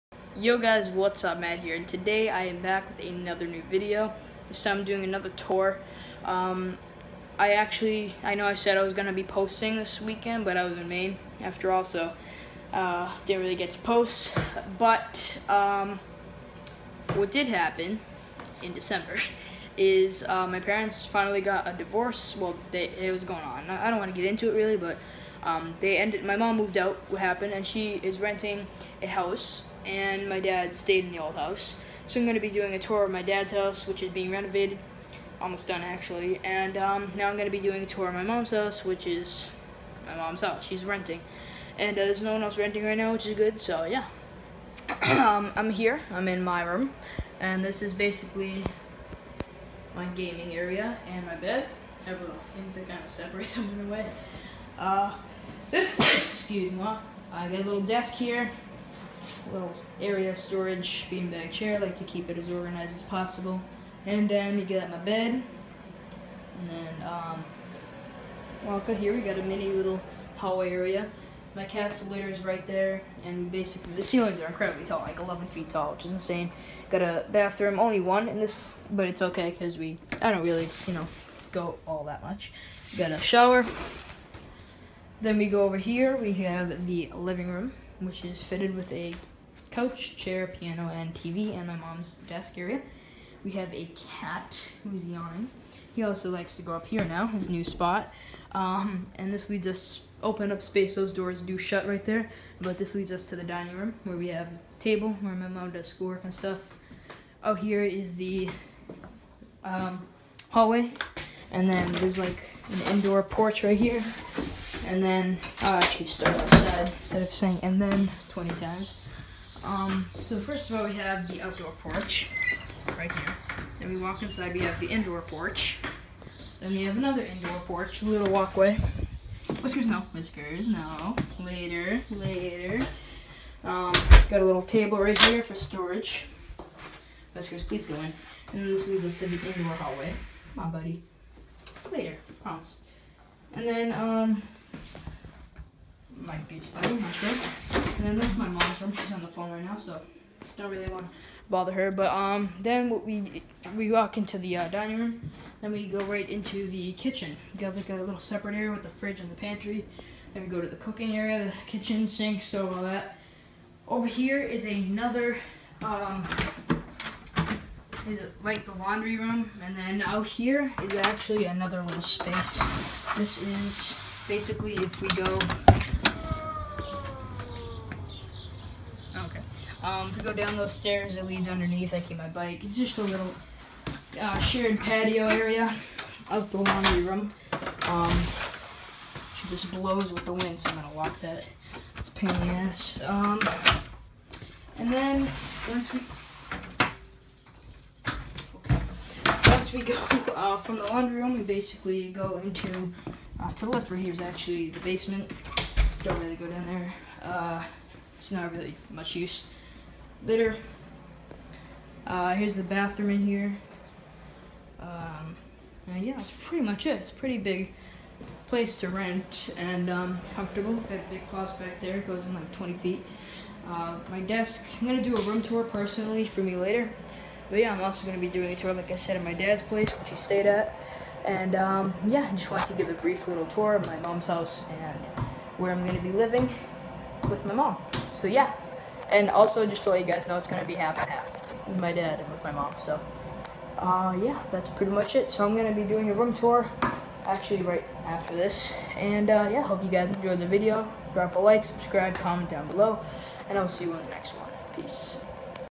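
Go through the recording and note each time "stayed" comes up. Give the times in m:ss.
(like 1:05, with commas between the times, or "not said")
0:30, 3:50.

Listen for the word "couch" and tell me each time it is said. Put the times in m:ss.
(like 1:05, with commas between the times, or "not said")
1:29.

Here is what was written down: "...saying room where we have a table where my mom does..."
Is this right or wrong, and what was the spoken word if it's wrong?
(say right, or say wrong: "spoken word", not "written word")
wrong: "dining", not "saying".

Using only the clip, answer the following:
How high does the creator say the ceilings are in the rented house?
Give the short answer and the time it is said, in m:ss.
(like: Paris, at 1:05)
11 feet, at 1:15.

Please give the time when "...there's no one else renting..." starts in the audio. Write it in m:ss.
0:42.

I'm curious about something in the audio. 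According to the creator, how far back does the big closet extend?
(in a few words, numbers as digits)
20 feet.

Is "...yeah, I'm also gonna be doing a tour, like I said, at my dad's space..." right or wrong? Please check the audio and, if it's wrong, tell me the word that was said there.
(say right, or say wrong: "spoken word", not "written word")
wrong: "place", not "space".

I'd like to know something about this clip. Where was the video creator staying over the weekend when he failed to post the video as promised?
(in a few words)
Maine.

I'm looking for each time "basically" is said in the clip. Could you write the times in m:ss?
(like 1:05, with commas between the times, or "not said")
0:47, 1:13, 2:54, 3:21.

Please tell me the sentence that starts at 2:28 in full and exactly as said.
She's on the phone right now, so don't really want to bother her.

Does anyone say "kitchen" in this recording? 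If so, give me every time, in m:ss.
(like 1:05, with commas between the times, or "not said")
2:36, 2:41.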